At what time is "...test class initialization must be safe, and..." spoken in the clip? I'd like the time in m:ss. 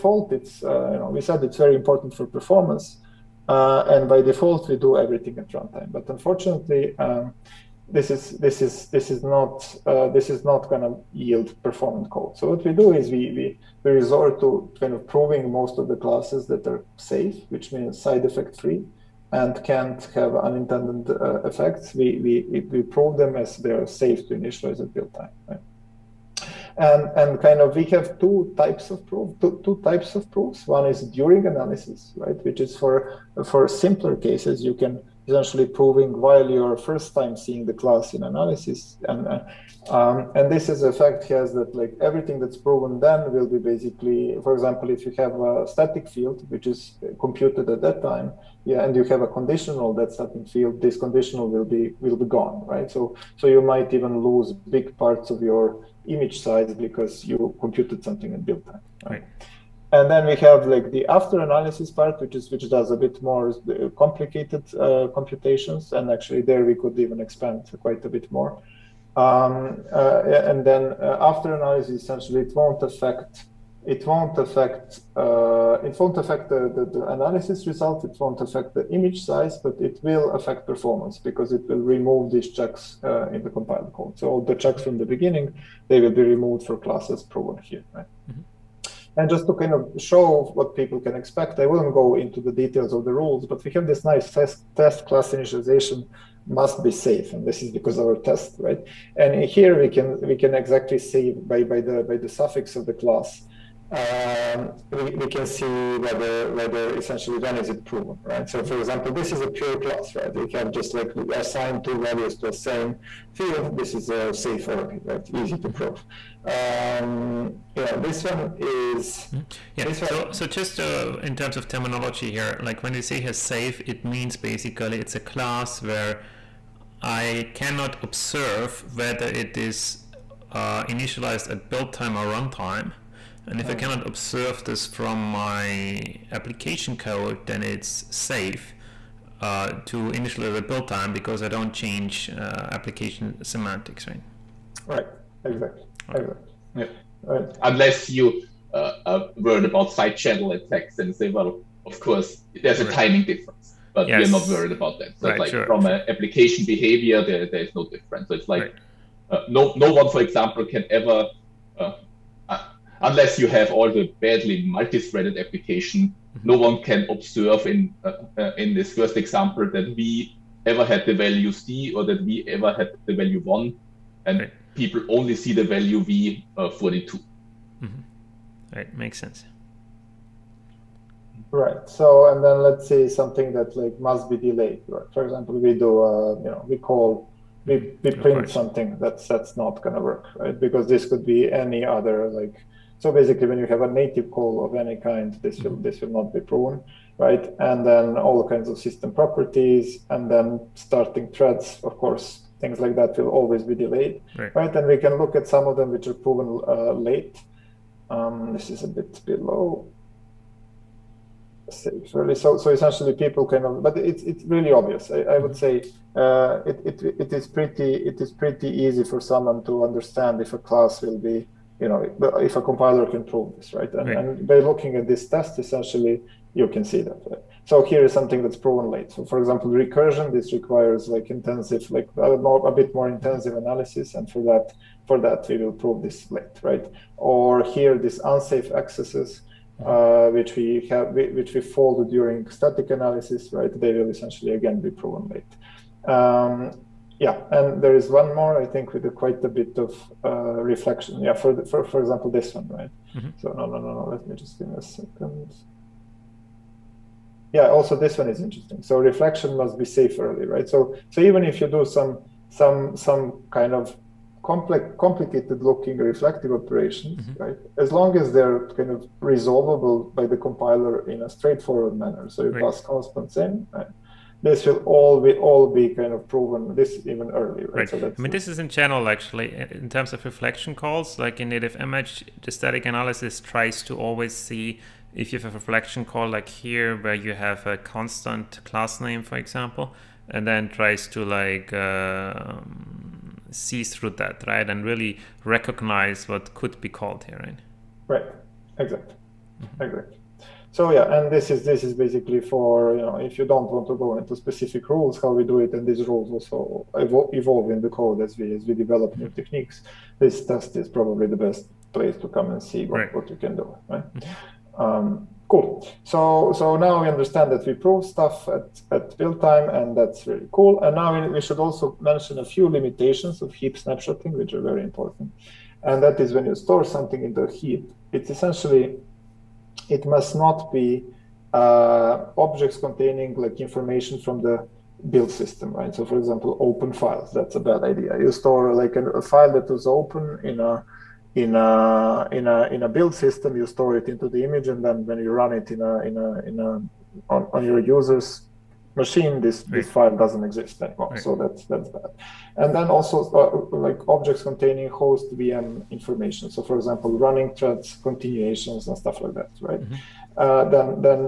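1:34.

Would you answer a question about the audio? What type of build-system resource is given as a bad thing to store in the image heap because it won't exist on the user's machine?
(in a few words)
open files.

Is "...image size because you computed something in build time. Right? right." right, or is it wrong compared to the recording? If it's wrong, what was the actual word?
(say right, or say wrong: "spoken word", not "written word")
right.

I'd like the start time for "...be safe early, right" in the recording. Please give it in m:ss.
4:19.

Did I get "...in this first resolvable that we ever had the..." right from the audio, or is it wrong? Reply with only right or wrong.
wrong.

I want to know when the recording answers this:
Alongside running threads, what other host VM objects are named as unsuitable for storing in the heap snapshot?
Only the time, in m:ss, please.
5:58.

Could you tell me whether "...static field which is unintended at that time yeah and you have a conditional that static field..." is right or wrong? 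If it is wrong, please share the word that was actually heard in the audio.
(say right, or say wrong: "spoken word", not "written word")
wrong: "computed", not "unintended".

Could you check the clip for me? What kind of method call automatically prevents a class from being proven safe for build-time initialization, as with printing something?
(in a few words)
native call.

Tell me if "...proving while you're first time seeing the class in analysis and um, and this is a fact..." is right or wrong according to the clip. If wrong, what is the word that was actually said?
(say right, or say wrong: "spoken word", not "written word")
right.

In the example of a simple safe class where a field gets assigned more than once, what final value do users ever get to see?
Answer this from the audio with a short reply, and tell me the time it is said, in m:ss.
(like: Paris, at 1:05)
42, at 2:56.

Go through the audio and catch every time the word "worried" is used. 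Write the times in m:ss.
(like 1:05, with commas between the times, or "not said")
2:29, 2:34.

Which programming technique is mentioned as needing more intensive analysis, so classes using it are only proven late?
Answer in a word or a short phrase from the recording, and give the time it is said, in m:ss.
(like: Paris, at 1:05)
recursion, at 3:49.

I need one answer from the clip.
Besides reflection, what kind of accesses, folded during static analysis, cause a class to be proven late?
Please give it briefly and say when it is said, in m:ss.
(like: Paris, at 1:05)
unsafe accesses, at 3:58.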